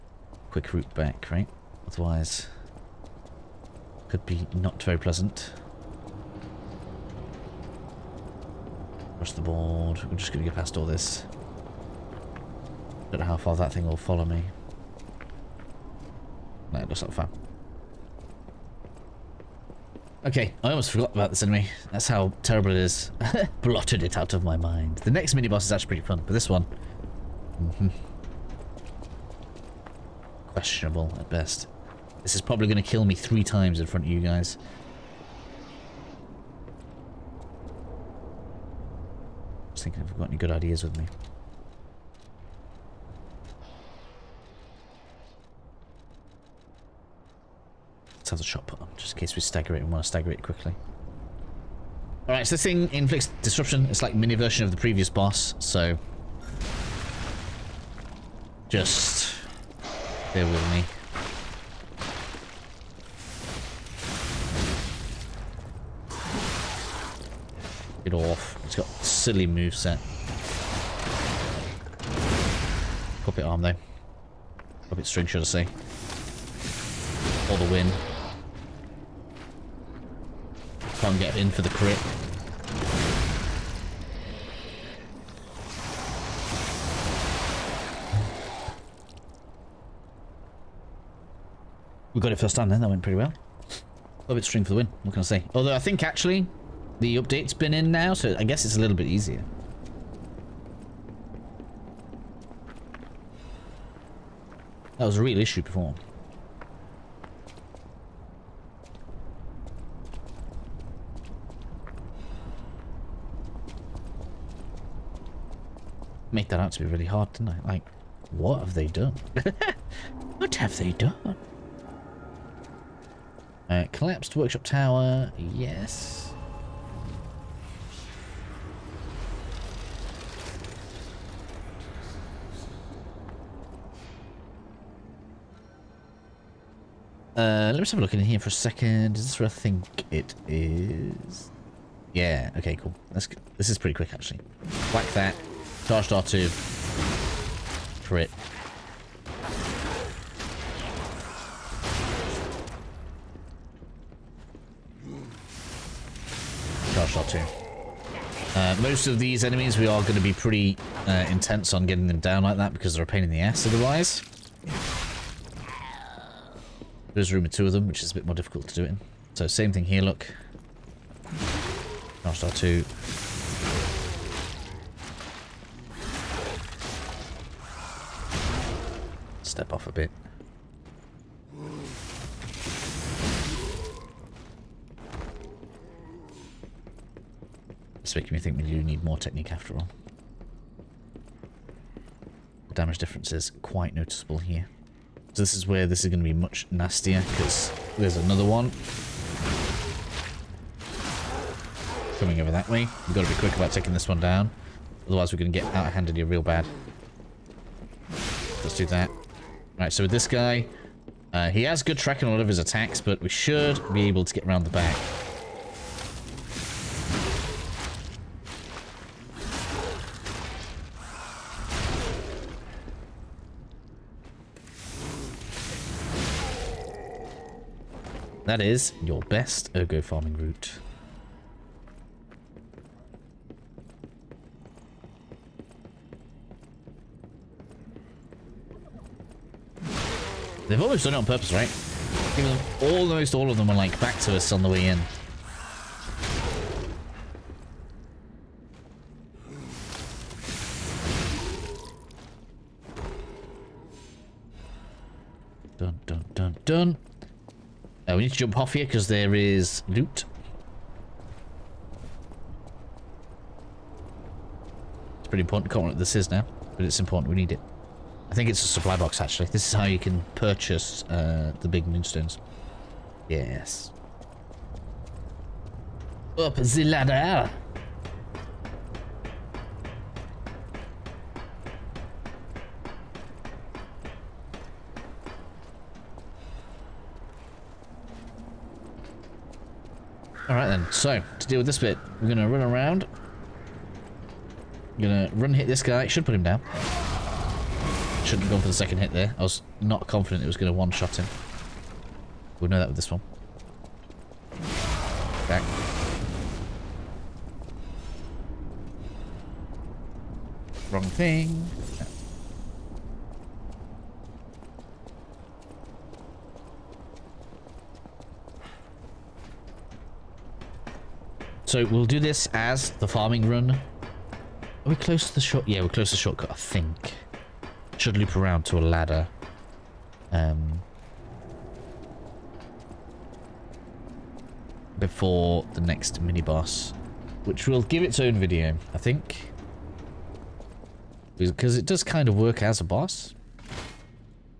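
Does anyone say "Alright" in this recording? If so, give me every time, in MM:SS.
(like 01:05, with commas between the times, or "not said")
00:52, 04:50.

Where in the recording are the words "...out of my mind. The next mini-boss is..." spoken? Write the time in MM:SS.
00:24.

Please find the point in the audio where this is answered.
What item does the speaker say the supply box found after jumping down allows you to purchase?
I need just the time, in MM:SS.
04:31.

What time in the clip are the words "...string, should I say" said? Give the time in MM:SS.
01:15.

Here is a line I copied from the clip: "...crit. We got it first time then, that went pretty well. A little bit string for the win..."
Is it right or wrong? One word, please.
right.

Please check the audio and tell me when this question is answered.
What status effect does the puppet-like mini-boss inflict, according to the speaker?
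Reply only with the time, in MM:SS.
00:53.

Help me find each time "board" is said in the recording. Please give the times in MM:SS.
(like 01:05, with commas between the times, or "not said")
00:09.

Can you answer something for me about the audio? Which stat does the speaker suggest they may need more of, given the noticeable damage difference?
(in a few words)
Technique.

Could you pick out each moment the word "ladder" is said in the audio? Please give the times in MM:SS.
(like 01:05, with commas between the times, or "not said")
04:36, 05:28.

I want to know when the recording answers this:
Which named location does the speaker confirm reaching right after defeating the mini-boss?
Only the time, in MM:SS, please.
02:03.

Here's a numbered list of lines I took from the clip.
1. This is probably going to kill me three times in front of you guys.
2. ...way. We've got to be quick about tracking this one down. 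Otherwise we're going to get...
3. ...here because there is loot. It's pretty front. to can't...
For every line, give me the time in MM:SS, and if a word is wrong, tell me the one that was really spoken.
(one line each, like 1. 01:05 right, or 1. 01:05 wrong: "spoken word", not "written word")
1. 00:32 right
2. 03:22 wrong: "taking", not "tracking"
3. 04:18 wrong: "important", not "front".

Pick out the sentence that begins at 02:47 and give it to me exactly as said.
There's room for two of them, which is a bit more difficult to do it in.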